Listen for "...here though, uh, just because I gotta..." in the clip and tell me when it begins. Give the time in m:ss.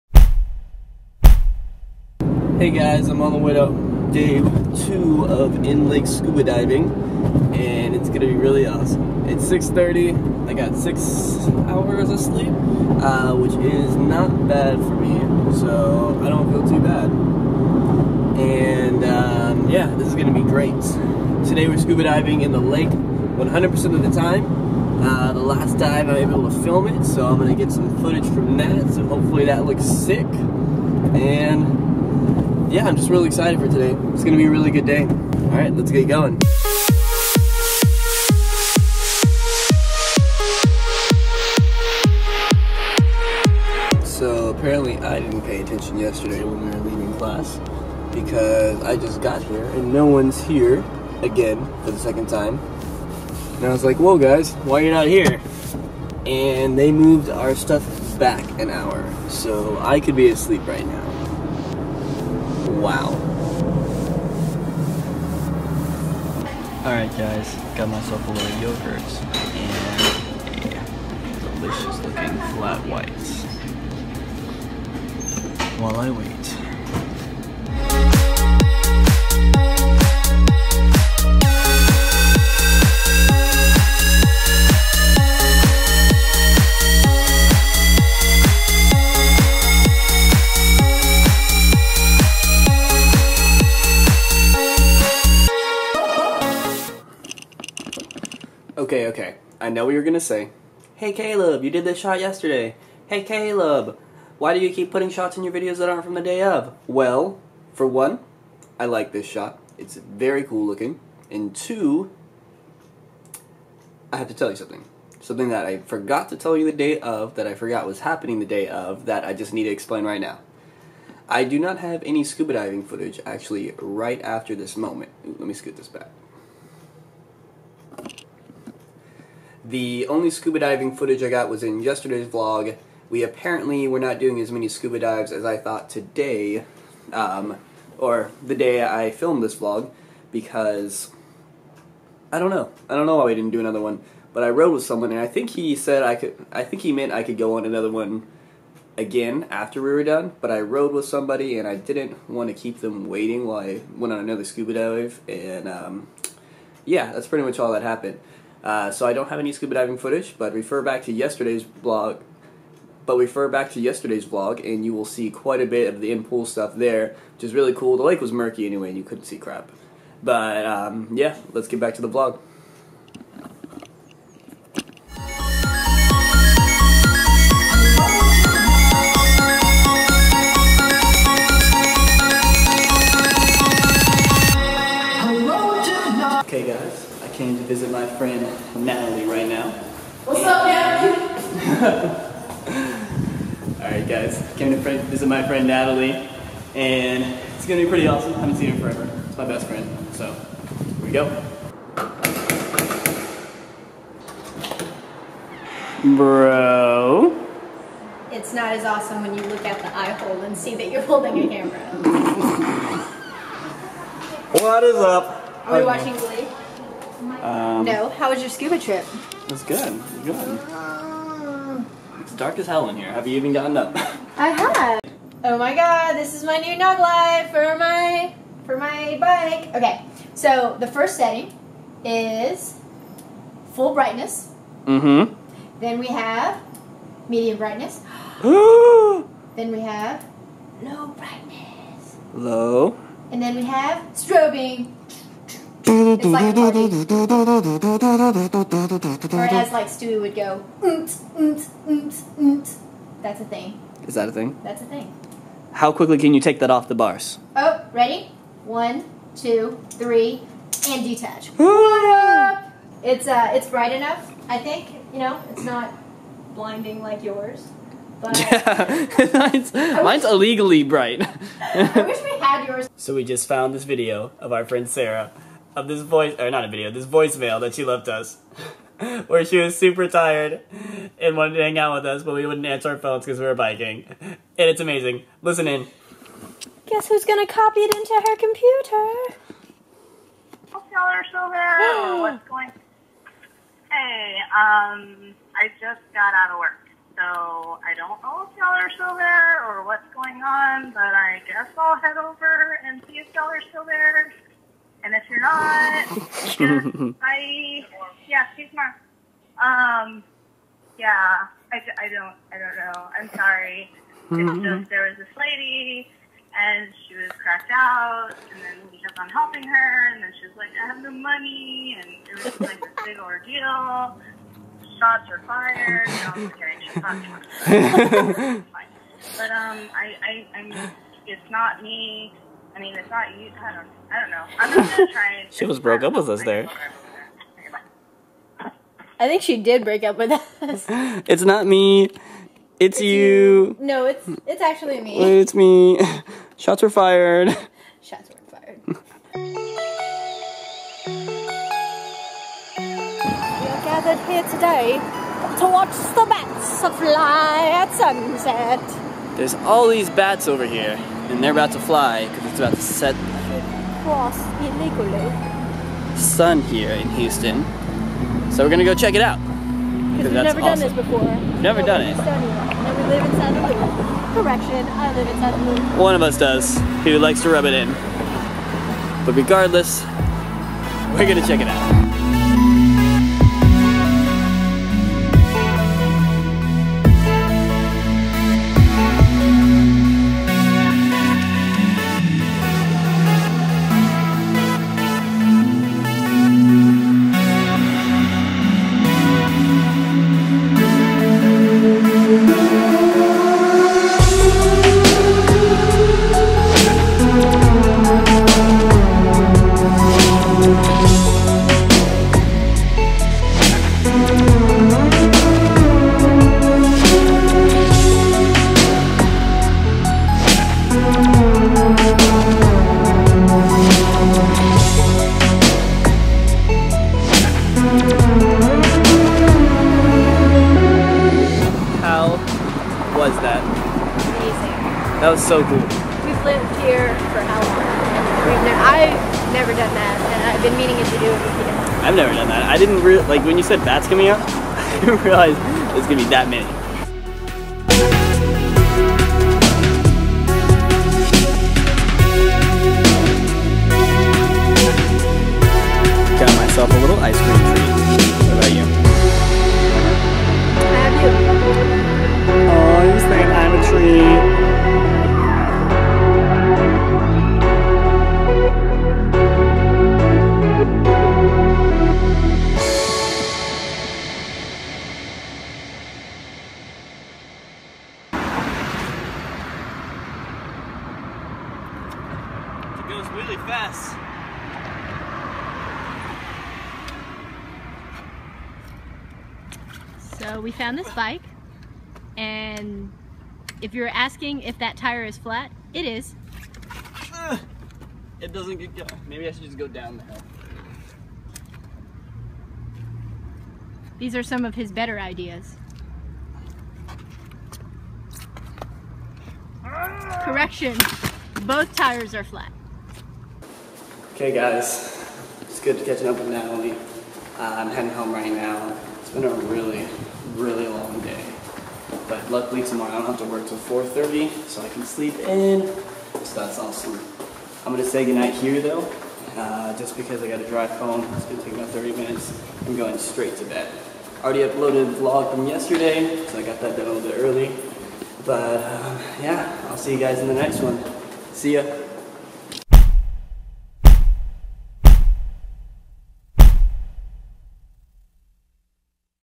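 8:48.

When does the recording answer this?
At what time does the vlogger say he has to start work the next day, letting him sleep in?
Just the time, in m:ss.
8:43.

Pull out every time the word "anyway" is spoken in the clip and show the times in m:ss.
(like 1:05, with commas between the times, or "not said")
2:48.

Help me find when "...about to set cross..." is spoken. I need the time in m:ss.
6:02.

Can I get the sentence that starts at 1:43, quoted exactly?
Hey Caleb, why do you keep putting shots in your videos that aren't from the day of?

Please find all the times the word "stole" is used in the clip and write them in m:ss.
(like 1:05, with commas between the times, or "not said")
not said.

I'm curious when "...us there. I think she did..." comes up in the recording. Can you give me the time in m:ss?
5:36.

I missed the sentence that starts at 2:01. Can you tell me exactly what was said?
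I do not have any scuba diving footage actually right after this moment.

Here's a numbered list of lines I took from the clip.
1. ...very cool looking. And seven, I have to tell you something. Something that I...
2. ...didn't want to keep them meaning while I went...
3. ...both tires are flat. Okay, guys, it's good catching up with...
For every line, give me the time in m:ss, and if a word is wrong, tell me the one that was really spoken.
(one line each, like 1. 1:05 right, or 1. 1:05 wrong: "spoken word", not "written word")
1. 1:49 wrong: "two", not "seven"
2. 2:31 wrong: "waiting", not "meaning"
3. 8:31 right.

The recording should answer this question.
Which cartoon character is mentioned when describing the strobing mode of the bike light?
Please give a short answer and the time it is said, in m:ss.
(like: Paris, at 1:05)
Stewie, at 4:09.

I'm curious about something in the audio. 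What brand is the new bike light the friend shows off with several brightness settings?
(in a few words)
Knog.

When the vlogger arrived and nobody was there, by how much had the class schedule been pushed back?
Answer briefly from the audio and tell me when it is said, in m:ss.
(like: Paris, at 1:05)
an hour, at 0:58.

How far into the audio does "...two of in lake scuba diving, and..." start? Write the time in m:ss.
0:04.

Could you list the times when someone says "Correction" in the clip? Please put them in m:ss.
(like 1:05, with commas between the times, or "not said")
6:14, 8:30.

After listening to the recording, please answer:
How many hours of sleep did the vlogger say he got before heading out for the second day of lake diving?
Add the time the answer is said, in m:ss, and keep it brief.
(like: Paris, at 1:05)
6, at 0:10.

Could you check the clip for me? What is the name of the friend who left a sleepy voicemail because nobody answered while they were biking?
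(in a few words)
Sarah.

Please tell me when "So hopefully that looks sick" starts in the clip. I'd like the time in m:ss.
0:28.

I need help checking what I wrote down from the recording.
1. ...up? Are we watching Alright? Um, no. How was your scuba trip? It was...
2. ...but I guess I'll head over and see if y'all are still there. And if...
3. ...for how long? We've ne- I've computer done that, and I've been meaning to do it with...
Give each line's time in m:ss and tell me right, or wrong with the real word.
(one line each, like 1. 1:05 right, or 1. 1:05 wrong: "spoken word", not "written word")
1. 3:34 wrong: "Glee", not "Alright"
2. 5:00 right
3. 7:17 wrong: "never", not "computer".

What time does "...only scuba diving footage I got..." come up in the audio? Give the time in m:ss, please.
2:10.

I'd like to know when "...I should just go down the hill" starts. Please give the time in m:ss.
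8:19.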